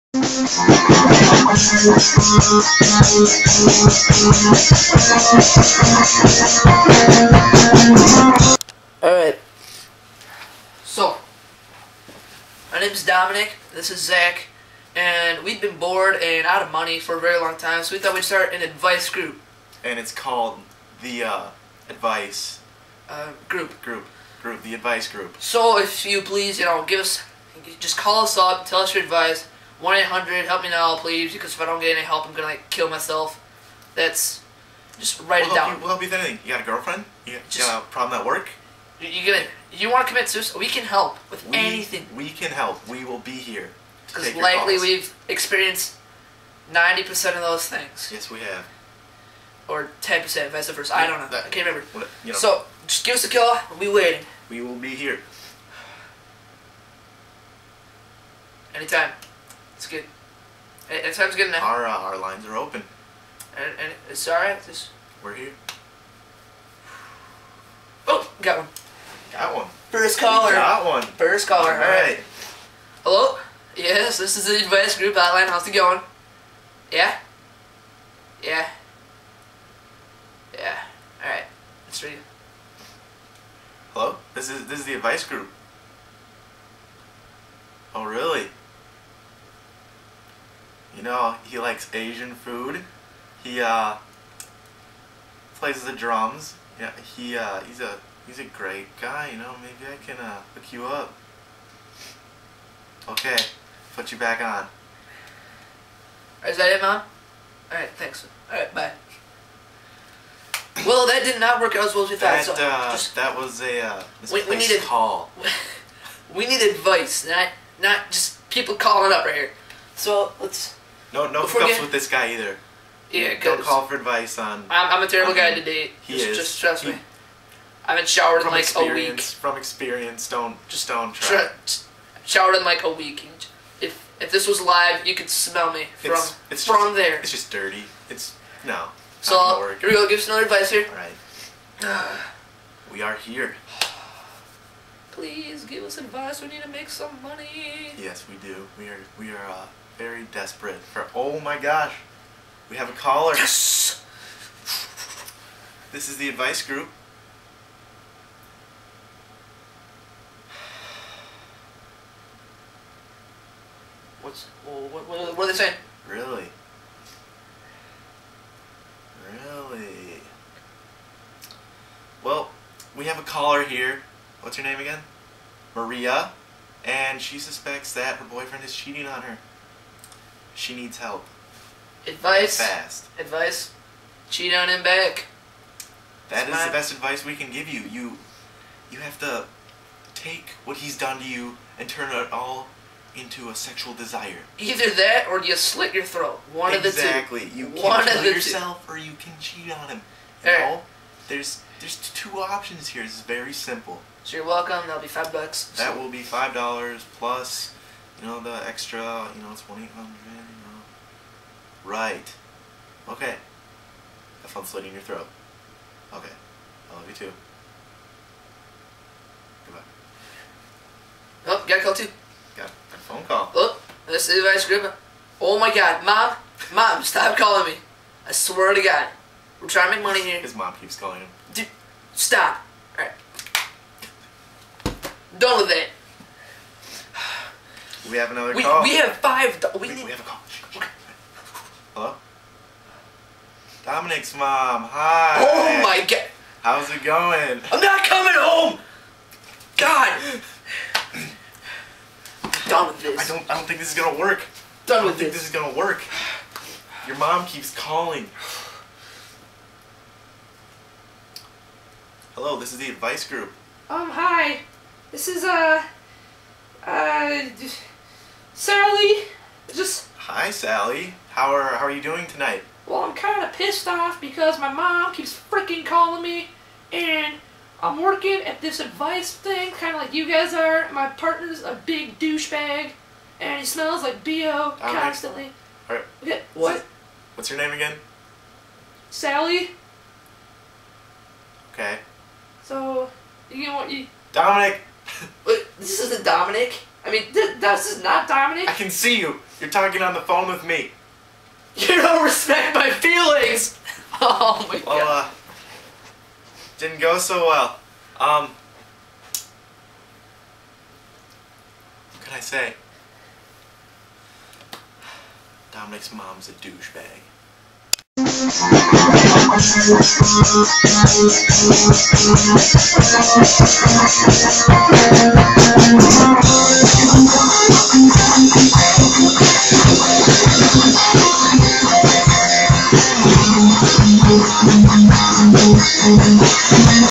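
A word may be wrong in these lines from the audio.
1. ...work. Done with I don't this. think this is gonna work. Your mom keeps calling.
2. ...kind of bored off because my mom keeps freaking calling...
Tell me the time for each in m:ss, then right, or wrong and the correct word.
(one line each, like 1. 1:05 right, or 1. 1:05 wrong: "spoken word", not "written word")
1. 4:14 right
2. 4:33 wrong: "pissed", not "bored".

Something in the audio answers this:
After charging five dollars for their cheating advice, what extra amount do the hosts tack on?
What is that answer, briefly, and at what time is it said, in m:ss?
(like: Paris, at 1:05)
2800, at 3:29.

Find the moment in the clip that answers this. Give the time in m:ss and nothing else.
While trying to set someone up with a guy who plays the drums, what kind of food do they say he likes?
1:31.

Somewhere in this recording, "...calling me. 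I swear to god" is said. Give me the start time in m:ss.
3:47.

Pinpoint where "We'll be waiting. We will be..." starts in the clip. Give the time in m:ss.
0:53.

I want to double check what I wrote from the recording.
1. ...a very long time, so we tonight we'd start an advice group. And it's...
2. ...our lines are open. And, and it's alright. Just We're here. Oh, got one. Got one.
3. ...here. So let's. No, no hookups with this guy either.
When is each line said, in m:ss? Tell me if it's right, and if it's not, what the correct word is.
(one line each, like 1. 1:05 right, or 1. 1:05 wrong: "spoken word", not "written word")
1. 0:17 wrong: "thought", not "tonight"
2. 1:01 right
3. 1:59 right.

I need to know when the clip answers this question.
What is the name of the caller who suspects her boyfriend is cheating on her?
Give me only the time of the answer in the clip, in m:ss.
2:55.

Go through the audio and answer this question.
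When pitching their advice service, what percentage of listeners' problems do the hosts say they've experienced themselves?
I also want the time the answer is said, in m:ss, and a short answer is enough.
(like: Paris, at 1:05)
90%, at 0:46.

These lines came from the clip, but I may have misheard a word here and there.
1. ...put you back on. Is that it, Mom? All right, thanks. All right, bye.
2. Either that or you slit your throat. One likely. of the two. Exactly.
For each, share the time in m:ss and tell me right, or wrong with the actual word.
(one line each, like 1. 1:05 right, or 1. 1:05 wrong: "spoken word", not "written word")
1. 1:43 right
2. 3:14 wrong: "exactly", not "likely".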